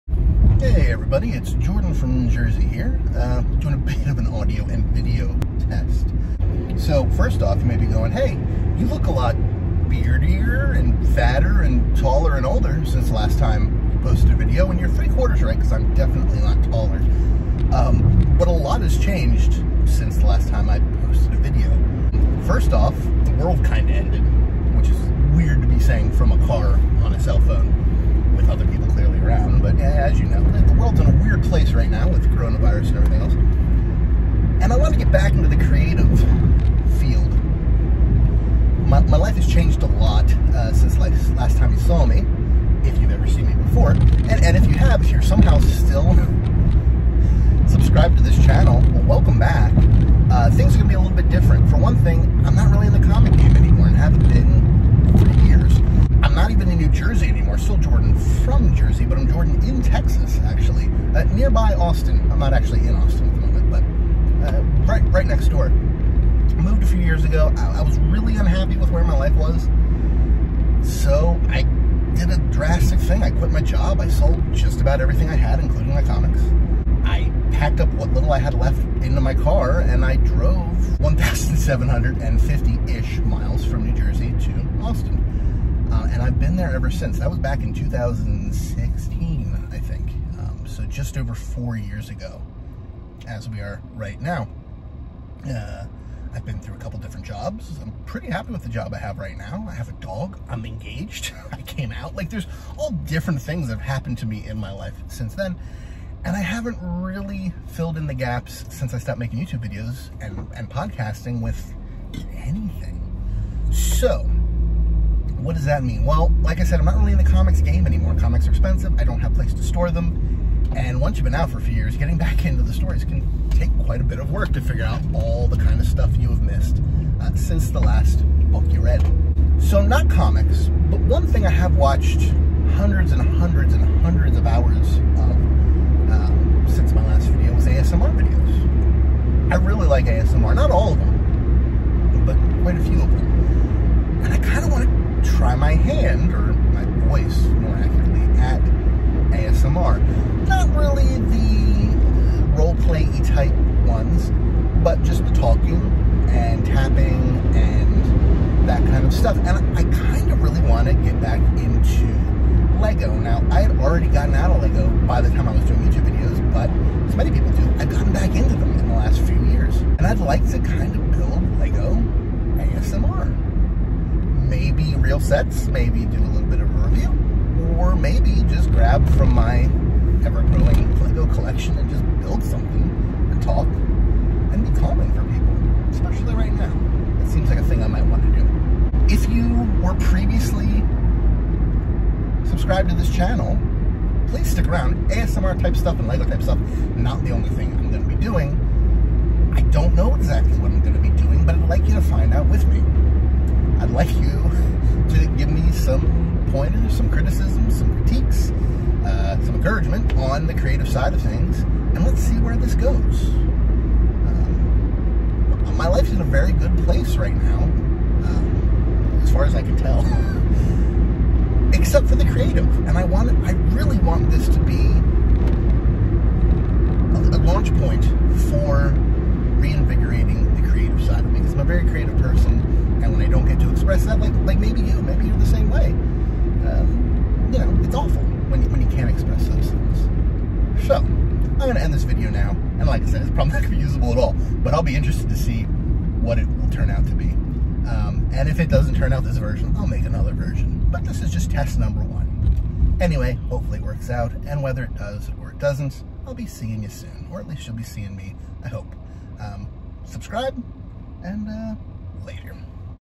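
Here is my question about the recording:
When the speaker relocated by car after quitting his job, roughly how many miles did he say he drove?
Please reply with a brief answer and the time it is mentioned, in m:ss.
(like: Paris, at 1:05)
1,750, at 1:20.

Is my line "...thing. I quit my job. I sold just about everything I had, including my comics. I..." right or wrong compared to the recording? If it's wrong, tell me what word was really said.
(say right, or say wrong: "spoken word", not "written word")
right.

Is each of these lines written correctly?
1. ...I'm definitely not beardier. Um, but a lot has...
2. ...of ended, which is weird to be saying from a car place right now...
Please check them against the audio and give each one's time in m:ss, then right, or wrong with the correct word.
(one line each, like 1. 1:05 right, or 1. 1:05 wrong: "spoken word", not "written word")
1. 0:15 wrong: "taller", not "beardier"
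2. 0:23 right.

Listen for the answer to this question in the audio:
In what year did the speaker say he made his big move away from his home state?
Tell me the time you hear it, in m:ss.
1:27.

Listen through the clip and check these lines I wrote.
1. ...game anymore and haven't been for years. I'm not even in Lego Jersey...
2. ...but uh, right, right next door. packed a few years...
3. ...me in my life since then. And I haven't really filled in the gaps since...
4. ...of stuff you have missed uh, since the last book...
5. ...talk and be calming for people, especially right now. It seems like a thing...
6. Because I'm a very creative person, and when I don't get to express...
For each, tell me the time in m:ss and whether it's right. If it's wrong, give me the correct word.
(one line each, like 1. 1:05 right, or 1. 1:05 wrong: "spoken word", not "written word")
1. 0:53 wrong: "New", not "Lego"
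2. 1:03 wrong: "moved", not "packed"
3. 1:44 right
4. 2:05 right
5. 3:03 right
6. 3:51 right.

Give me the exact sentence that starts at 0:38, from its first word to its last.
My, my life has changed a lot uh, since last, last time you saw me, if you've ever seen me before.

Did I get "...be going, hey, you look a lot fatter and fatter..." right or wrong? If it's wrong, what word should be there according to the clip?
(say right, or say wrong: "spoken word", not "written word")
wrong: "beardier", not "fatter".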